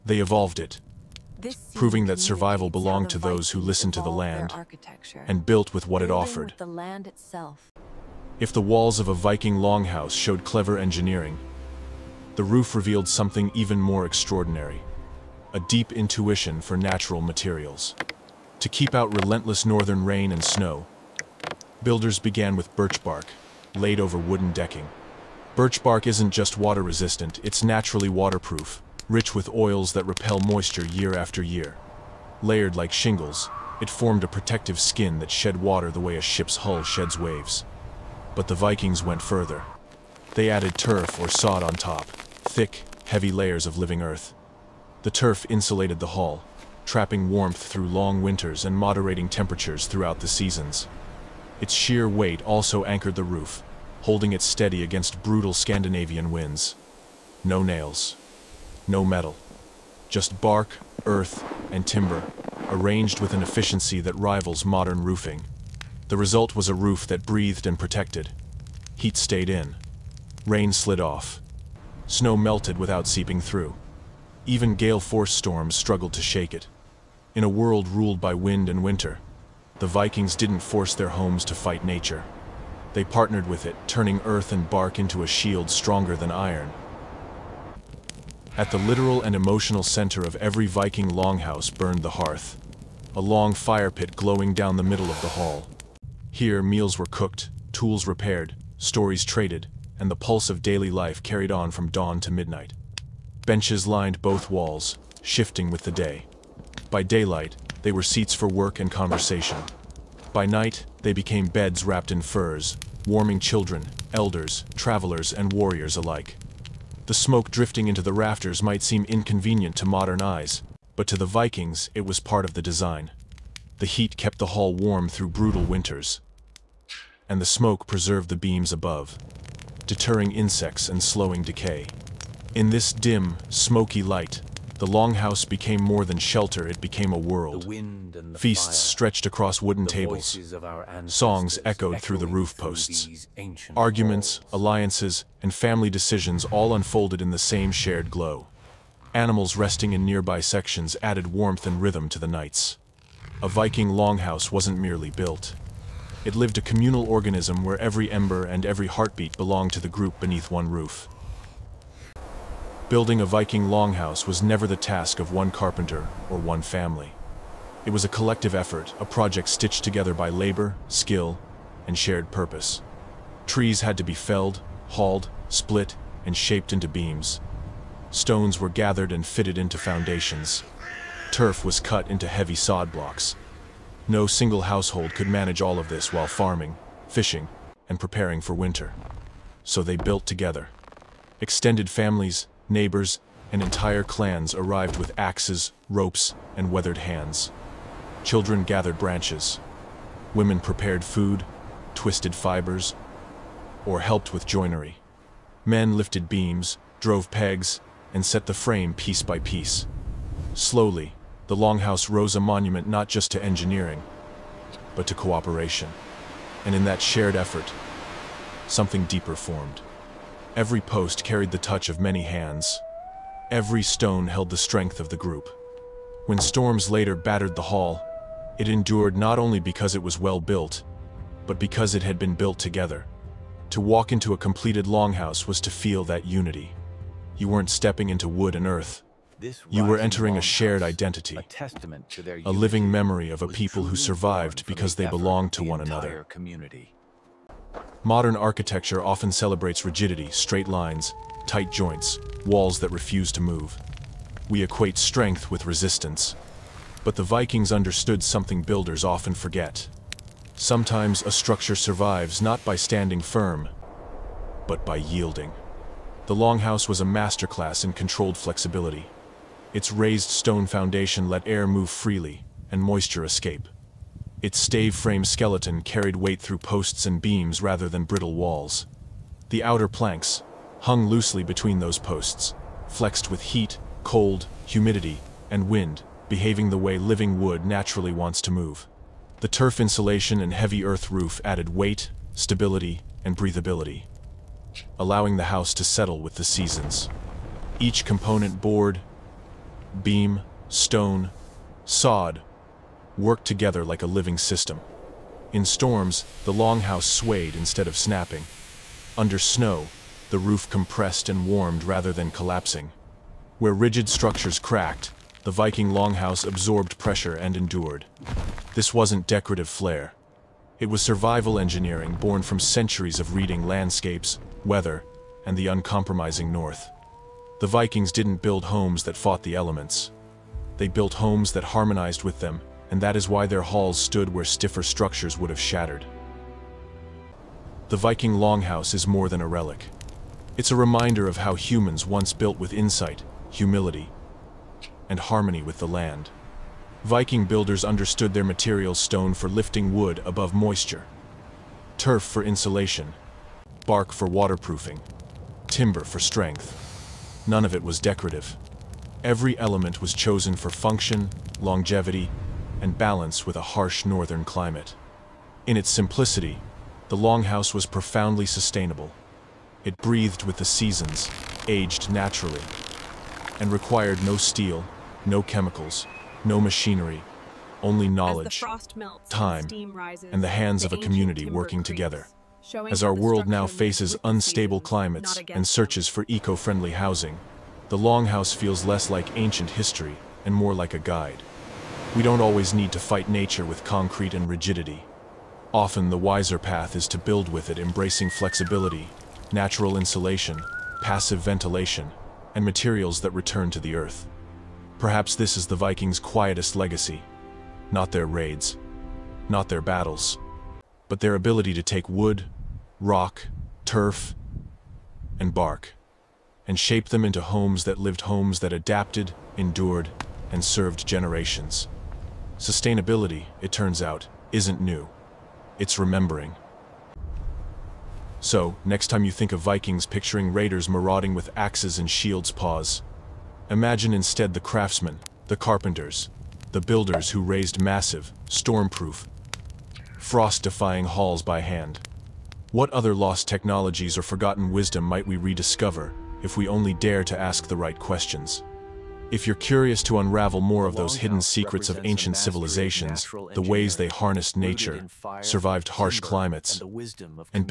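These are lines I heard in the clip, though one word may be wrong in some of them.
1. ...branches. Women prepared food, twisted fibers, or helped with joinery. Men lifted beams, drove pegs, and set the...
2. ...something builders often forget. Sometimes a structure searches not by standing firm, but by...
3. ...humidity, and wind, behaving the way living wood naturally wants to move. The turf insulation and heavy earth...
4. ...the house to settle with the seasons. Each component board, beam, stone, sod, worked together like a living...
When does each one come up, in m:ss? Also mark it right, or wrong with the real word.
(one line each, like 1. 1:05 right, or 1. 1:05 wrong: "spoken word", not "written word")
1. 3:18 right
2. 4:18 wrong: "survives", not "searches"
3. 4:44 right
4. 4:55 right.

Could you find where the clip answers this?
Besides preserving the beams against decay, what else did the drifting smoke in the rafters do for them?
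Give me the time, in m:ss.
2:09.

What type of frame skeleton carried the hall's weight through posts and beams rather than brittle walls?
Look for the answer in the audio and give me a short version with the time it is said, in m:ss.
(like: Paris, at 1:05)
Stave frame, at 4:34.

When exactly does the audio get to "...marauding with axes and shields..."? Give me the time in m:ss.
7:10.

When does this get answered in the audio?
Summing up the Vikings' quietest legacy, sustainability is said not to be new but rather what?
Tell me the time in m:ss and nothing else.
7:05.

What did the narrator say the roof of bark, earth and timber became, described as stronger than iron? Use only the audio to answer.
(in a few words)
A shield.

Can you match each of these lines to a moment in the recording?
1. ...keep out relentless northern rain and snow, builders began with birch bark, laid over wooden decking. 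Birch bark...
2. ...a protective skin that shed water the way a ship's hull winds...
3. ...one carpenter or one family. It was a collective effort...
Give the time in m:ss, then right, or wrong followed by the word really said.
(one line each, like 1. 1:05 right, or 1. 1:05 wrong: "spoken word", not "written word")
1. 0:18 right
2. 0:34 wrong: "sheds", not "winds"
3. 2:45 right.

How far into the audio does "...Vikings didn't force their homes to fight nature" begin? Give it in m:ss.
1:19.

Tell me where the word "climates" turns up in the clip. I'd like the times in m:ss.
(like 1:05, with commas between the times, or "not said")
6:04, 6:24, 7:36.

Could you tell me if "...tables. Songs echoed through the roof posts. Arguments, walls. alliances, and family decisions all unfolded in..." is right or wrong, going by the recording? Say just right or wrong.
right.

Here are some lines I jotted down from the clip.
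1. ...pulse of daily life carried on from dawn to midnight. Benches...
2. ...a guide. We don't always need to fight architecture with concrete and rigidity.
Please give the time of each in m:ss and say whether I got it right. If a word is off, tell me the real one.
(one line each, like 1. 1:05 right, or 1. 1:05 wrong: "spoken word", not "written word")
1. 1:40 right
2. 6:30 wrong: "nature", not "architecture".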